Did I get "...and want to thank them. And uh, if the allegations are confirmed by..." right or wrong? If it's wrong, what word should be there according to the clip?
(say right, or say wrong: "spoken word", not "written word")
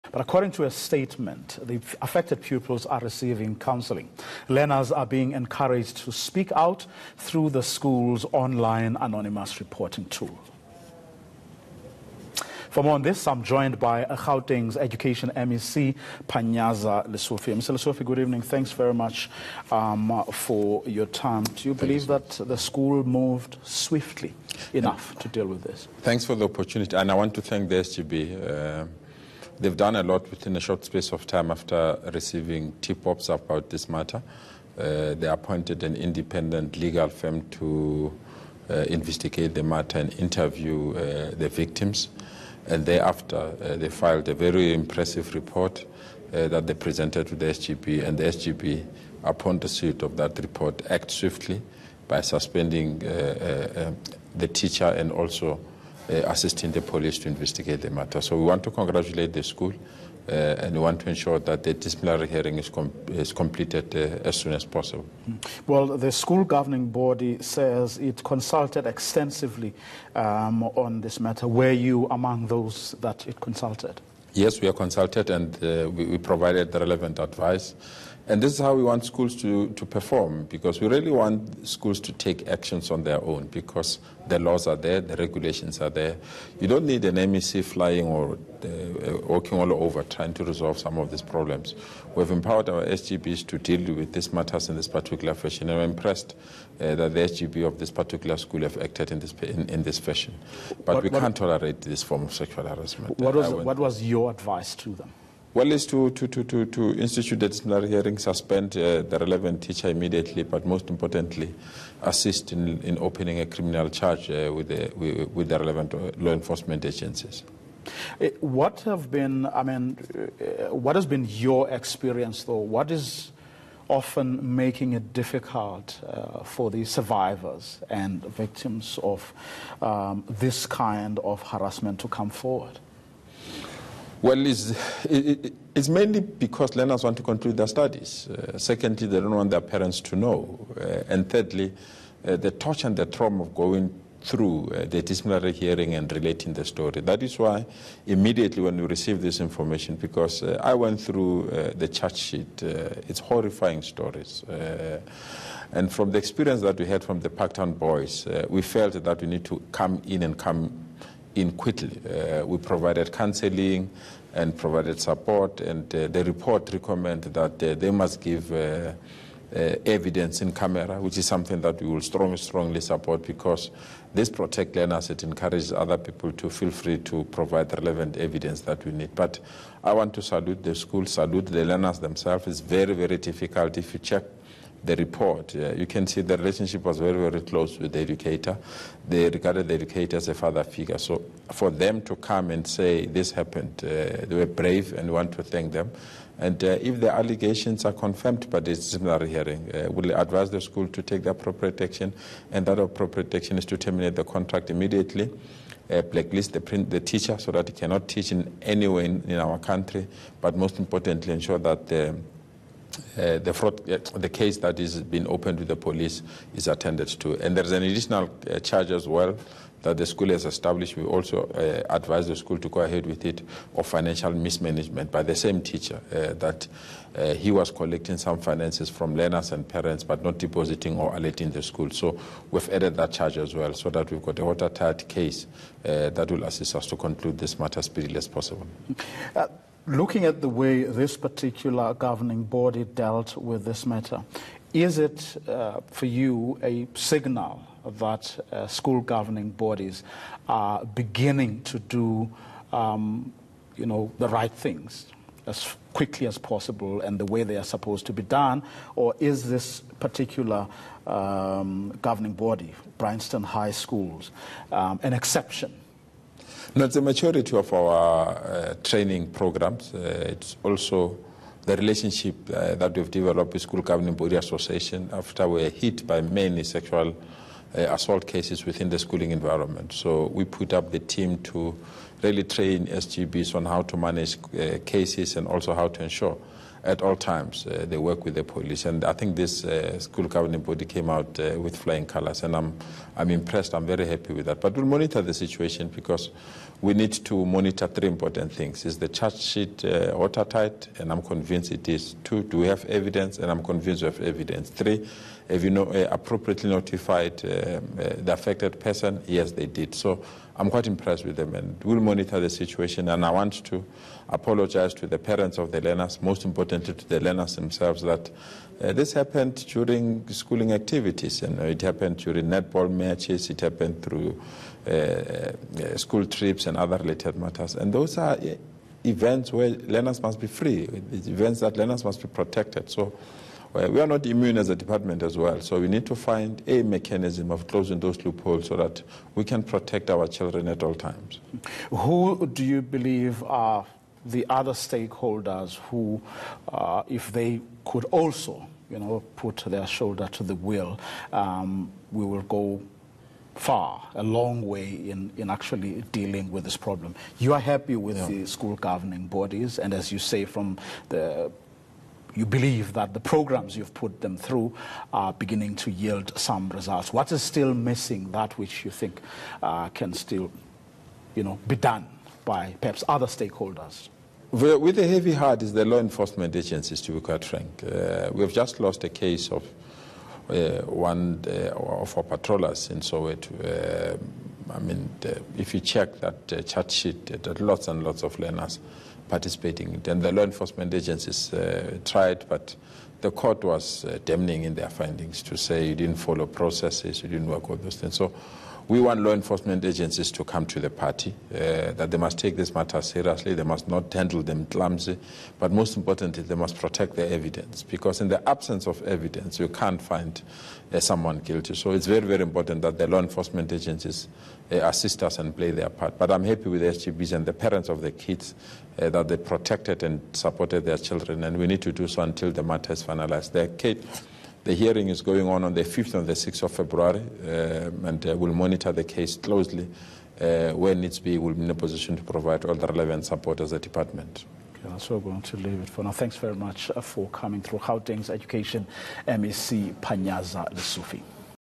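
right.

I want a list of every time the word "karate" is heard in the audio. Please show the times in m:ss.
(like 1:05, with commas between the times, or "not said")
not said.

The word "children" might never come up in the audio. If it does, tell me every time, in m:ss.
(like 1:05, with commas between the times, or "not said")
5:40, 7:00.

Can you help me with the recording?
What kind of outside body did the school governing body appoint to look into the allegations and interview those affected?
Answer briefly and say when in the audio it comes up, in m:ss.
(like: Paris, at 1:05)
independent legal firm, at 0:35.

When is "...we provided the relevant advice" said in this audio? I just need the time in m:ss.
1:16.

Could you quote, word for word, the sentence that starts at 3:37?
And there's an additional uh, charge as well that the school has established.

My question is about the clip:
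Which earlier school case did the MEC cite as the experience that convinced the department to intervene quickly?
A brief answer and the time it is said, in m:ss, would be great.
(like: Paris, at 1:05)
Parktown boys, at 2:37.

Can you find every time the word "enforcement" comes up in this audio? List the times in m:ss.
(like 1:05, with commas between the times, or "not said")
1:56, 6:15, 6:30, 6:39, 6:53.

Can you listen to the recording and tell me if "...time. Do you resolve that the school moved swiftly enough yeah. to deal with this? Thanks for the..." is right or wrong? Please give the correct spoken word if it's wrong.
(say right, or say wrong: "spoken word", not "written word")
wrong: "believe", not "resolve".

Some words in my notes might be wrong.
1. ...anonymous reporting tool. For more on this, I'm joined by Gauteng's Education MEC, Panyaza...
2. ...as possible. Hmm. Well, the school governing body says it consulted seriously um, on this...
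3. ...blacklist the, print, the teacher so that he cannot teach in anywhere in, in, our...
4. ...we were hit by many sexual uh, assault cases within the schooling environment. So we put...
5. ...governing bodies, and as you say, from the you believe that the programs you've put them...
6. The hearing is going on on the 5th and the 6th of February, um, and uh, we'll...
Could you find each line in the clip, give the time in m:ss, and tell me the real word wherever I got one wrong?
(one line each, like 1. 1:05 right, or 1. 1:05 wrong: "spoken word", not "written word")
1. 0:08 right
2. 1:04 wrong: "extensively", not "seriously"
3. 3:26 right
4. 4:35 right
5. 5:58 right
6. 7:04 right.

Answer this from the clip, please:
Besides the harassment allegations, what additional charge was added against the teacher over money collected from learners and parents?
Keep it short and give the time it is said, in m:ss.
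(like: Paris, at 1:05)
financial mismanagement, at 3:43.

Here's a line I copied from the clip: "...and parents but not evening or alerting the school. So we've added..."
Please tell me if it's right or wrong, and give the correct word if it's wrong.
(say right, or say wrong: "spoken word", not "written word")
wrong: "depositing", not "evening".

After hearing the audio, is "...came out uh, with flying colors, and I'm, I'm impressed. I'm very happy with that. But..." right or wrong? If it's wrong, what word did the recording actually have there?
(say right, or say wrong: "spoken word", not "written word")
right.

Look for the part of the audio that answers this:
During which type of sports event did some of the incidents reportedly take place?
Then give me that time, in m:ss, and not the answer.
5:22.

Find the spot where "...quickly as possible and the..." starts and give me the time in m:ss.
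4:15.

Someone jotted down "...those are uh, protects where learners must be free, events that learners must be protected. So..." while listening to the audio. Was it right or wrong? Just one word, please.
wrong.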